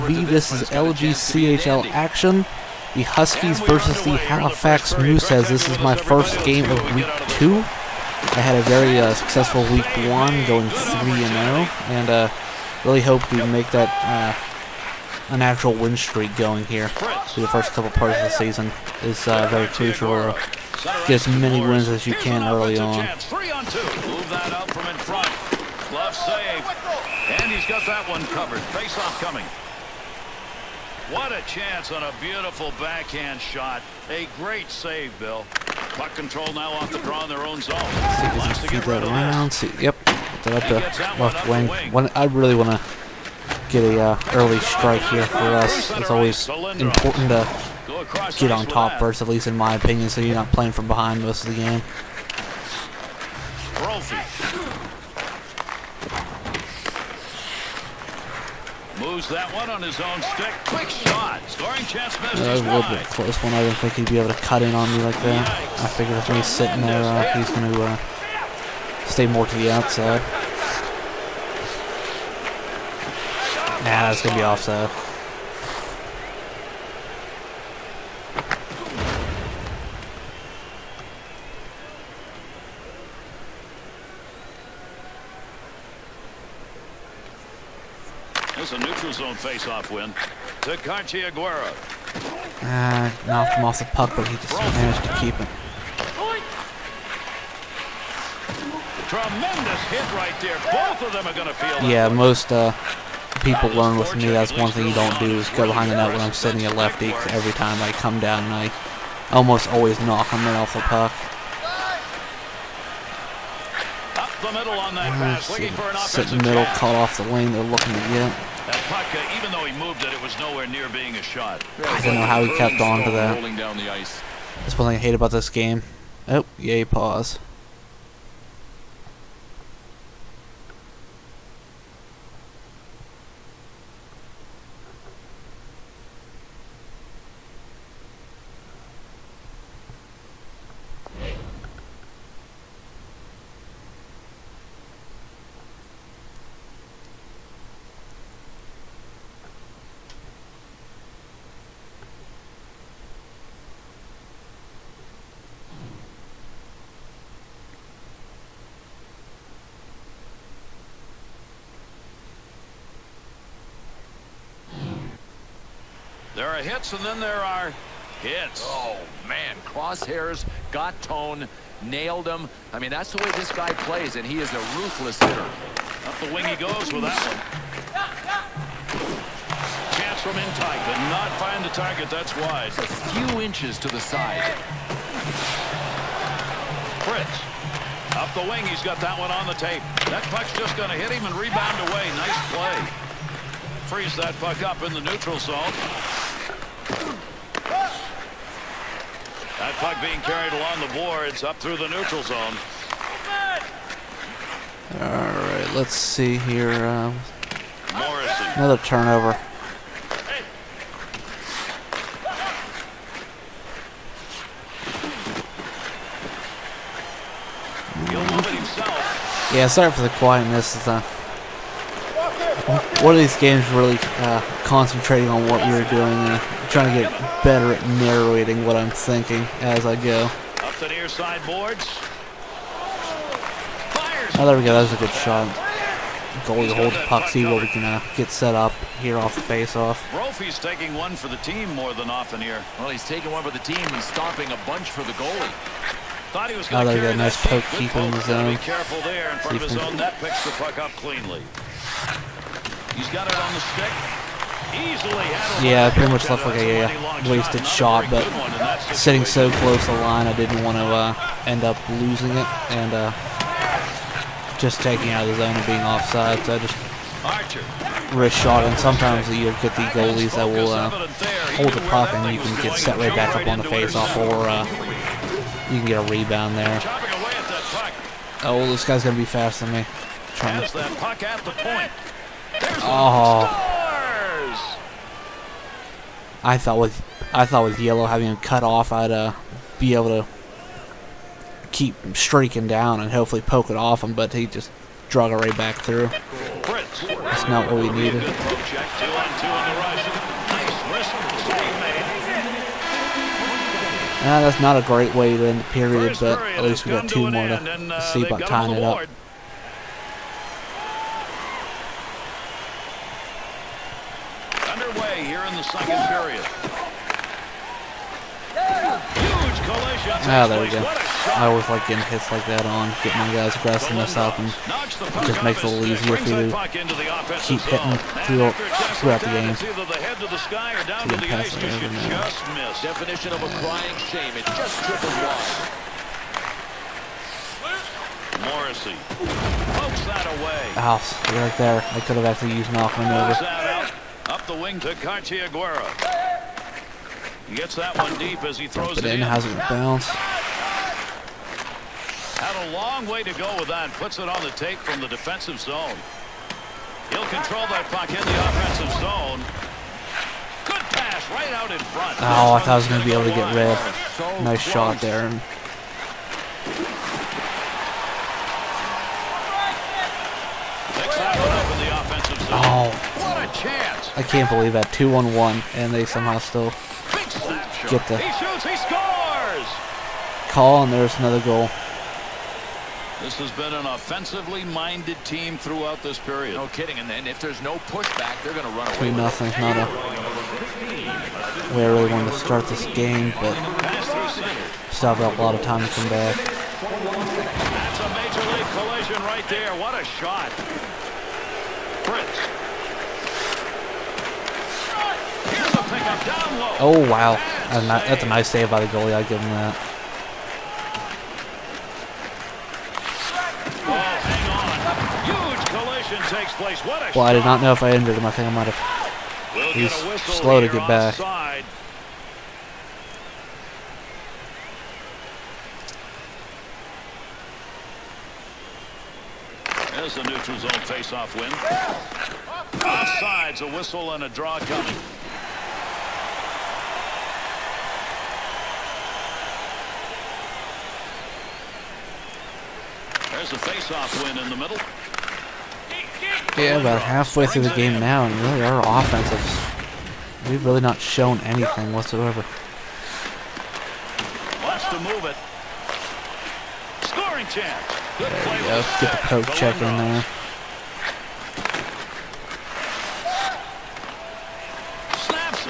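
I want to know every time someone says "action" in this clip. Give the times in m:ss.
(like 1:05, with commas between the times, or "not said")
0:01.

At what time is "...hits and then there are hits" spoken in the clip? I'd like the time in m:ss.
2:46.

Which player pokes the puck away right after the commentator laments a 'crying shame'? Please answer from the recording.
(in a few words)
Morrissey.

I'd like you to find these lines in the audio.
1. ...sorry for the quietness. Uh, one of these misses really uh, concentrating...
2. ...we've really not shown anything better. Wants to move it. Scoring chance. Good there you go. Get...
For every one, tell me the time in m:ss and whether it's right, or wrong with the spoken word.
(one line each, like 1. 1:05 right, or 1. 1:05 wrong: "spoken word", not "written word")
1. 3:39 wrong: "games", not "misses"
2. 7:30 wrong: "whatsoever", not "better".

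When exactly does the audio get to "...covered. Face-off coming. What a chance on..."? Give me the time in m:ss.
0:28.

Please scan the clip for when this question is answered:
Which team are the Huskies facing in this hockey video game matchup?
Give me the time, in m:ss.
0:04.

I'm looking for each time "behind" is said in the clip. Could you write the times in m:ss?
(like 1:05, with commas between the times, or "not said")
0:50, 1:45.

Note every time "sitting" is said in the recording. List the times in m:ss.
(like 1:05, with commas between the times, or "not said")
1:06, 1:46, 4:18.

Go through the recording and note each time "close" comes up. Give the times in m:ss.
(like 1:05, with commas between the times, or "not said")
1:03, 4:19.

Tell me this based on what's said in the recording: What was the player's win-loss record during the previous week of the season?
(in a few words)
3 and 0.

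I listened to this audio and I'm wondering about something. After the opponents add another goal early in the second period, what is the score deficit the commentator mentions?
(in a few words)
3 nothing.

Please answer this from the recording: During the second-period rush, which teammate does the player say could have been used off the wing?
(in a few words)
Malcolm.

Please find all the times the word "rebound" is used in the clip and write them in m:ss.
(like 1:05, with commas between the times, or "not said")
3:11, 4:36.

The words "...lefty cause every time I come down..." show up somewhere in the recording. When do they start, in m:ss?
1:46.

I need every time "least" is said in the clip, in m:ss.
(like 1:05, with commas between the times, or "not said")
0:49, 5:06.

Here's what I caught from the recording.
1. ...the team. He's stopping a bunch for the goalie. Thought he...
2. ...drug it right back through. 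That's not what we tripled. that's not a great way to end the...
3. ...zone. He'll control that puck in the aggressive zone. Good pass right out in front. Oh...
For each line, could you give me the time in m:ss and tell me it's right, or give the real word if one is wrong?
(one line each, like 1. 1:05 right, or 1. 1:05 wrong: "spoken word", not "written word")
1. 4:03 right
2. 4:55 wrong: "needed", not "tripled"
3. 5:55 wrong: "offensive", not "aggressive".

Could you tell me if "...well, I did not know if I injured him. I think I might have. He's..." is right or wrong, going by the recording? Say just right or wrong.
right.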